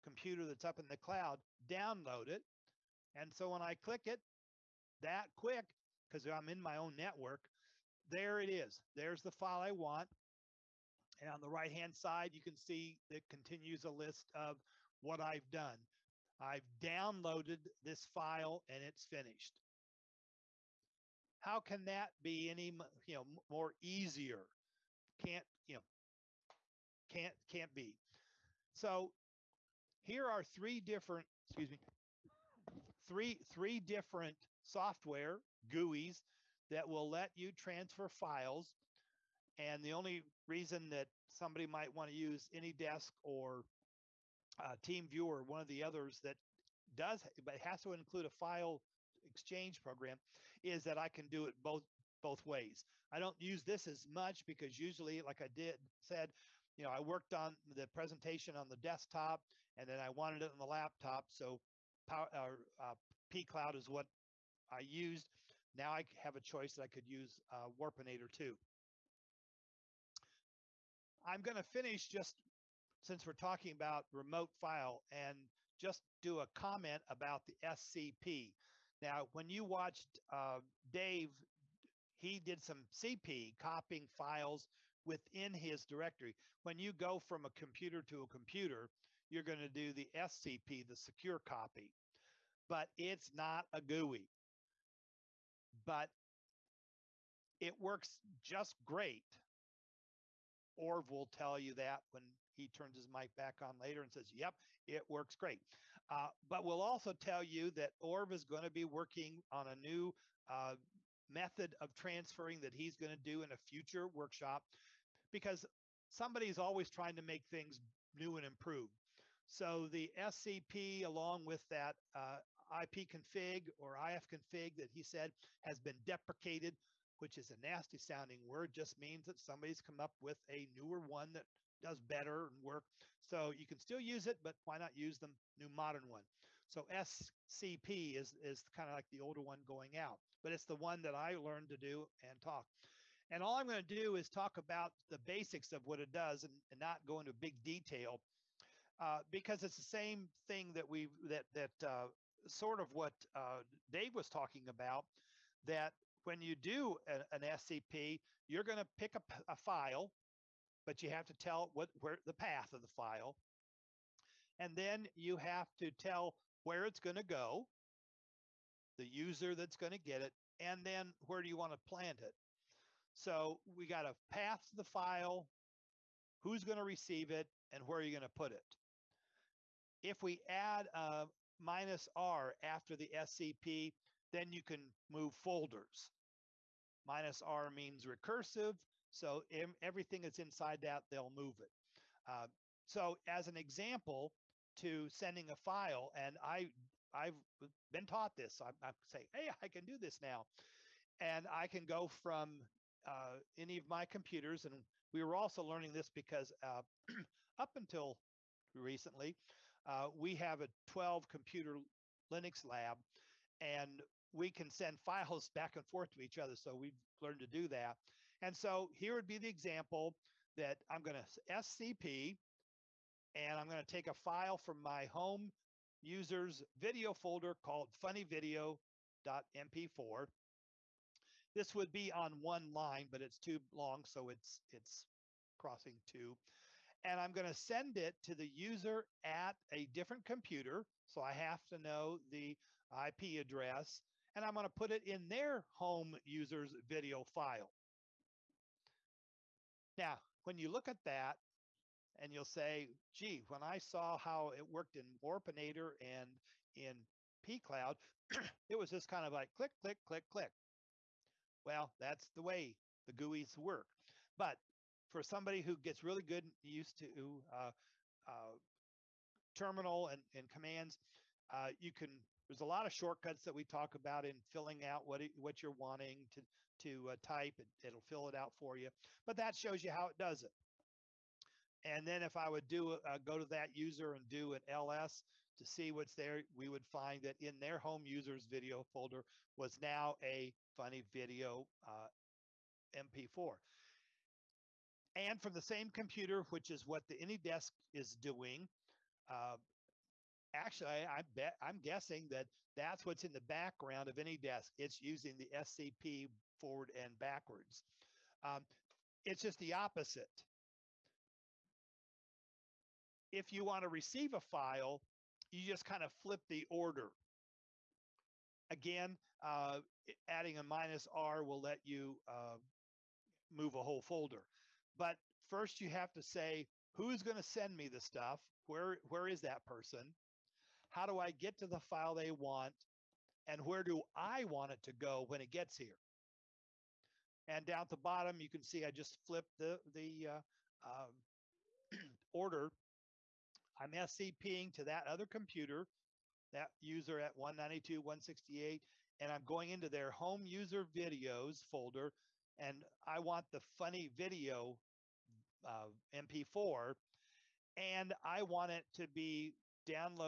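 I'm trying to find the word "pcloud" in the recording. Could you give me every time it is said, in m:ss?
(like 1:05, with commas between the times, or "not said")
1:03, 4:17.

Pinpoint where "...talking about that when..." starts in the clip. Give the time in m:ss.
2:34.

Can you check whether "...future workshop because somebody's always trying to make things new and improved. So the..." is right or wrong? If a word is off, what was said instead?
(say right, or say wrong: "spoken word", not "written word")
right.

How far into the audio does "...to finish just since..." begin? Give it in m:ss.
1:11.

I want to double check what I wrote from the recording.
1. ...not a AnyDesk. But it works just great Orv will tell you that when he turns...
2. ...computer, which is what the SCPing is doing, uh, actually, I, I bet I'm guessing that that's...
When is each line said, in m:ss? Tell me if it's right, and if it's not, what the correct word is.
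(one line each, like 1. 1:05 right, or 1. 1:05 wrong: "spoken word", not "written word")
1. 1:33 wrong: "GUI", not "AnyDesk"
2. 4:55 wrong: "AnyDesk", not "SCPing".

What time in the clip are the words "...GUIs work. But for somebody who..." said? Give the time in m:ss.
4:23.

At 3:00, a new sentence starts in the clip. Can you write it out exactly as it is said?
If we add a minus R after the SCP, then you can move folders minus R means recursive.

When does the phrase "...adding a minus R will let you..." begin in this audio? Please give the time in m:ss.
5:20.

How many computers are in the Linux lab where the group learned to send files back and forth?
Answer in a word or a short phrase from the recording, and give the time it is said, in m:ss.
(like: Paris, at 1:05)
12, at 3:30.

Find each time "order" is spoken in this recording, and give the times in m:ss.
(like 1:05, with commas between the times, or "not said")
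5:16, 5:42.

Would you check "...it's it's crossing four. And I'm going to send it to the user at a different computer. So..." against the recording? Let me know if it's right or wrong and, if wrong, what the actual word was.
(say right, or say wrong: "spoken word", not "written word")
wrong: "two", not "four".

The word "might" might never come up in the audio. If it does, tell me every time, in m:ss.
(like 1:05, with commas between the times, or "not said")
0:41.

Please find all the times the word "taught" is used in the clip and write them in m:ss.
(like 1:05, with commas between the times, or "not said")
3:18.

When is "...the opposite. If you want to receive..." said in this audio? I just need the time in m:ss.
5:09.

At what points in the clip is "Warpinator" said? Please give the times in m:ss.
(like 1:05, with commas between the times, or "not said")
1:07, 4:15.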